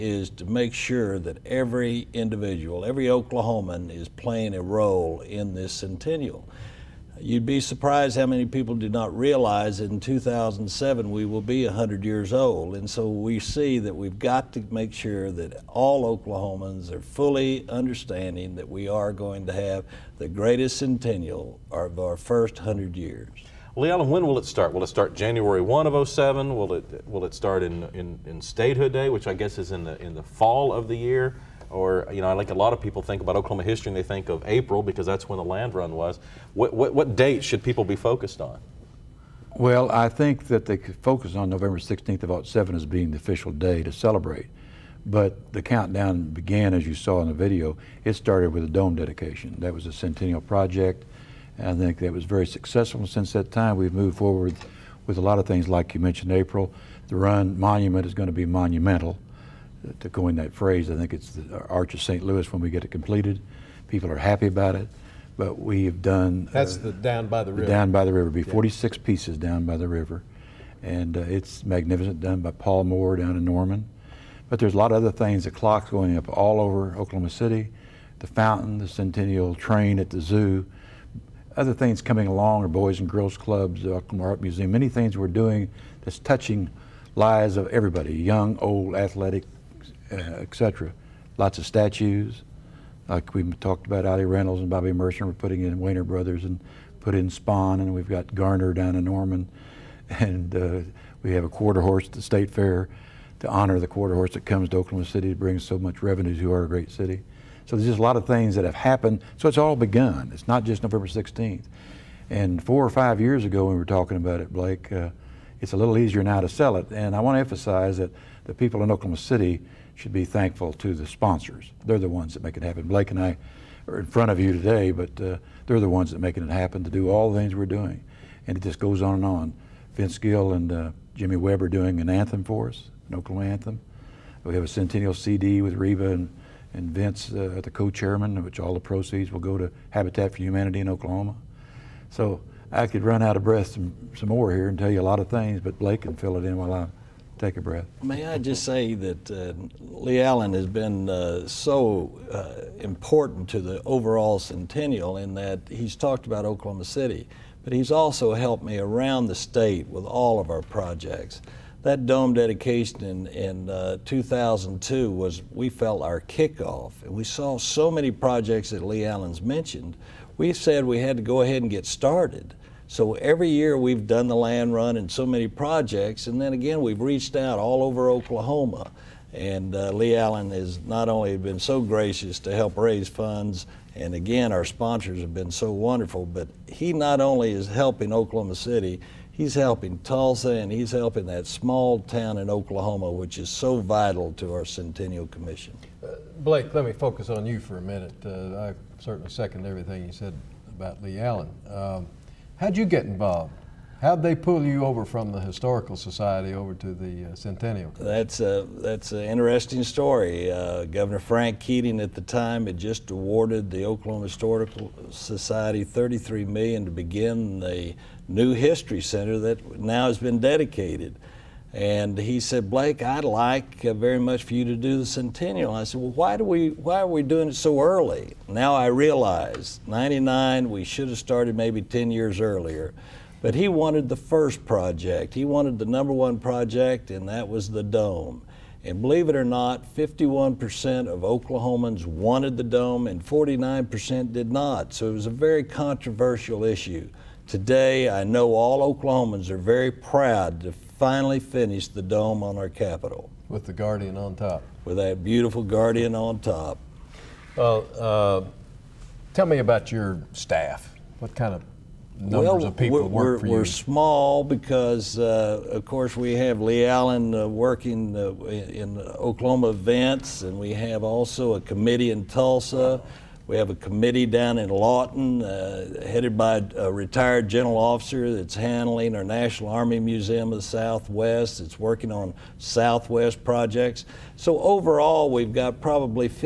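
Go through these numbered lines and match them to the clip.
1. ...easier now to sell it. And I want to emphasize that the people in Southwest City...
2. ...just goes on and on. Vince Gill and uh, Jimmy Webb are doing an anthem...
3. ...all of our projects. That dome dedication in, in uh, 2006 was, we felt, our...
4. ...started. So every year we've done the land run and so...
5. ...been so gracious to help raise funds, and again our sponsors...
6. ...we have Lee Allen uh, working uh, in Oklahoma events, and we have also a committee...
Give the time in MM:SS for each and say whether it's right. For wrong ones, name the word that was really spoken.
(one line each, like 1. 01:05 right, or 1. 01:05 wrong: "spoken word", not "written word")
1. 01:55 wrong: "Oklahoma", not "Southwest"
2. 02:08 right
3. 02:40 wrong: "2002", not "2006"
4. 02:51 right
5. 03:01 right
6. 04:26 right.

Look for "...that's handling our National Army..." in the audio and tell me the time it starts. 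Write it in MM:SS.
04:38.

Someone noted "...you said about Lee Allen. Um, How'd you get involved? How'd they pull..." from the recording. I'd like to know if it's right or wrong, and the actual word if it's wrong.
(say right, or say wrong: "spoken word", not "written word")
right.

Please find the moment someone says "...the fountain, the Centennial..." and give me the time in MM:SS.
01:18.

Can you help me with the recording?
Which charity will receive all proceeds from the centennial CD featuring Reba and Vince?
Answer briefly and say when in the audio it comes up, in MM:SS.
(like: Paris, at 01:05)
Habitat for Humanity, at 02:19.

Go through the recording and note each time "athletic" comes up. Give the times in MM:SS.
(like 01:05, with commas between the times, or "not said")
01:28.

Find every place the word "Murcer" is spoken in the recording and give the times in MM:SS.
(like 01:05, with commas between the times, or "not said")
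01:34.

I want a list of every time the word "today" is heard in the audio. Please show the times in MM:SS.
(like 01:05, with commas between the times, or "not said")
02:04, 04:07.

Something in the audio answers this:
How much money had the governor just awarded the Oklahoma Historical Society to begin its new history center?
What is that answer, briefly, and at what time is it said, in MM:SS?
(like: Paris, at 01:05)
$33 million, at 03:35.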